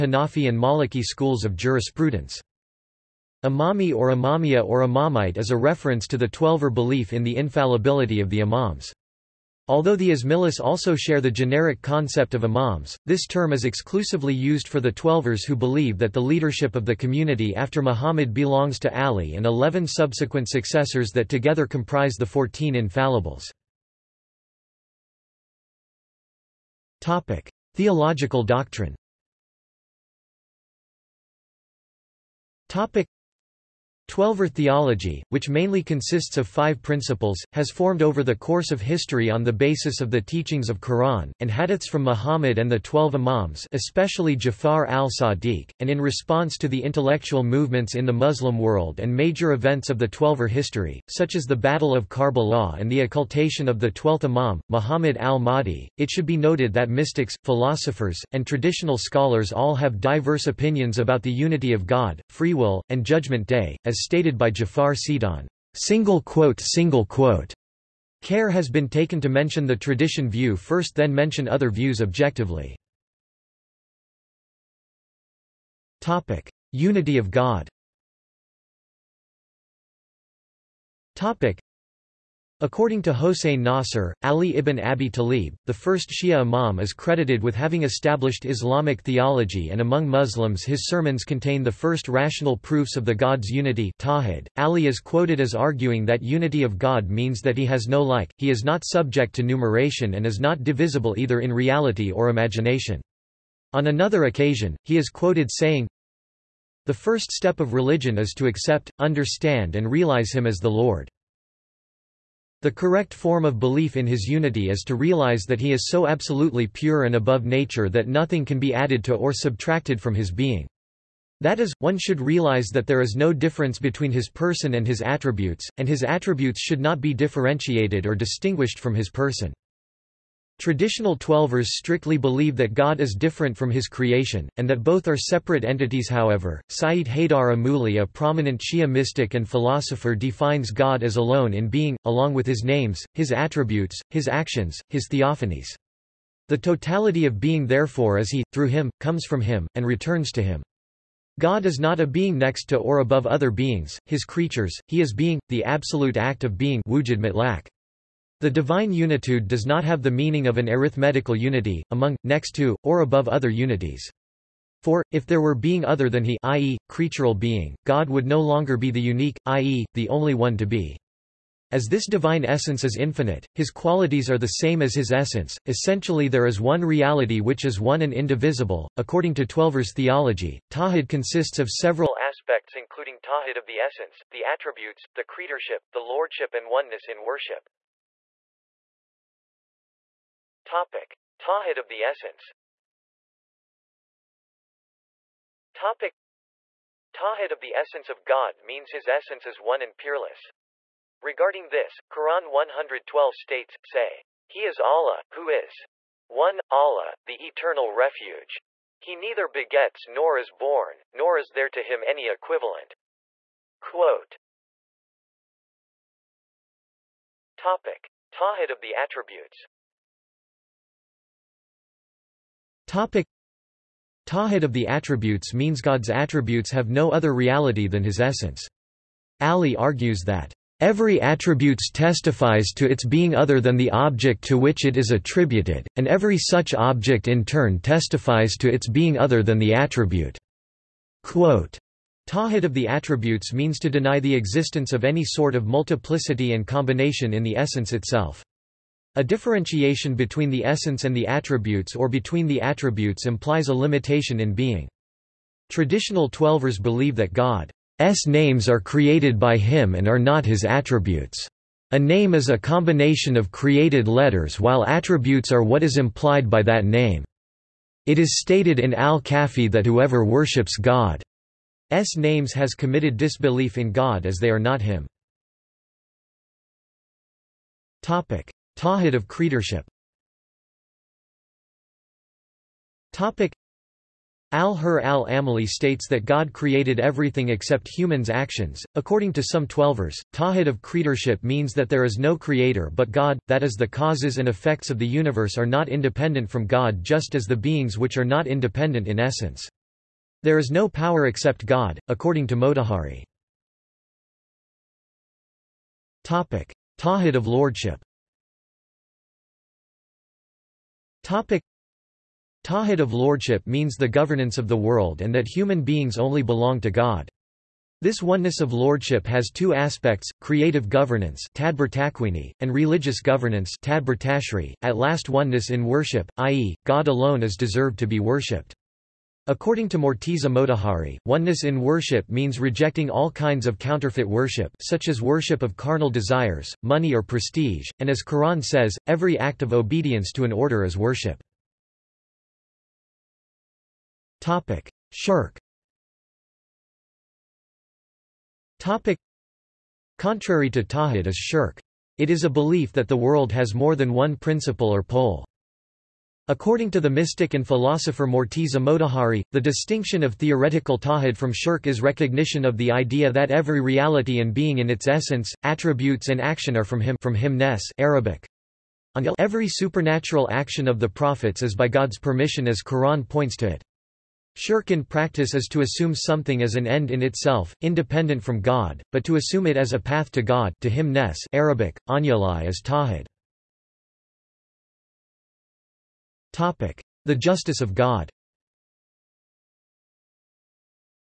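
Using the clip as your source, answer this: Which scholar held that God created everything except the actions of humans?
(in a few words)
Al-Hurr al-Amili.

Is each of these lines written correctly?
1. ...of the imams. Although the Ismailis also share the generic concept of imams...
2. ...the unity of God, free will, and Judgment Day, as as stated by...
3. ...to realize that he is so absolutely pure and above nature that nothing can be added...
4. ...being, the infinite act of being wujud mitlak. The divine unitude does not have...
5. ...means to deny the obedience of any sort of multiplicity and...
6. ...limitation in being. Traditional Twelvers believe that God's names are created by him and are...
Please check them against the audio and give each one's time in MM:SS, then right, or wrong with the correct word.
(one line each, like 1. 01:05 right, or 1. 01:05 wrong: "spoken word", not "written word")
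1. 00:08 right
2. 01:01 right
3. 01:54 right
4. 02:35 wrong: "absolute", not "infinite"
5. 04:03 wrong: "existence", not "obedience"
6. 04:13 right.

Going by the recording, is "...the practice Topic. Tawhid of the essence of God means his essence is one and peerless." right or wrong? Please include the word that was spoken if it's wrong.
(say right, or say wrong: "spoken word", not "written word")
wrong: "essence", not "practice".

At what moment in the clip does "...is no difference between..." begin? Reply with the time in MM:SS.
02:03.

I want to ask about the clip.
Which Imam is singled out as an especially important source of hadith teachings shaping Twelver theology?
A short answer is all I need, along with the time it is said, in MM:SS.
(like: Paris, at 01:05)
Jafar al-Sadiq, at 00:44.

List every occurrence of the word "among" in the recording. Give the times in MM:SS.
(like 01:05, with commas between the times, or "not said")
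01:29, 02:41.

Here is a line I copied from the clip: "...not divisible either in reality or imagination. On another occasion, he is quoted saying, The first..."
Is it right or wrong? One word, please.
right.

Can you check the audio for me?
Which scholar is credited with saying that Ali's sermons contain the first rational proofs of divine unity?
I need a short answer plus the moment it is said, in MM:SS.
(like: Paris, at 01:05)
Hossein Nasr, at 01:23.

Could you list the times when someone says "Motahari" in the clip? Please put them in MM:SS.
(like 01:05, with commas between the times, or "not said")
05:02, 05:30, 05:58.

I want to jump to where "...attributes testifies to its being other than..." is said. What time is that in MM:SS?
03:51.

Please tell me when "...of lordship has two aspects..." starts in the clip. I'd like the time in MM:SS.
05:18.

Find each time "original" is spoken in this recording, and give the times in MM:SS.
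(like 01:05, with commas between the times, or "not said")
not said.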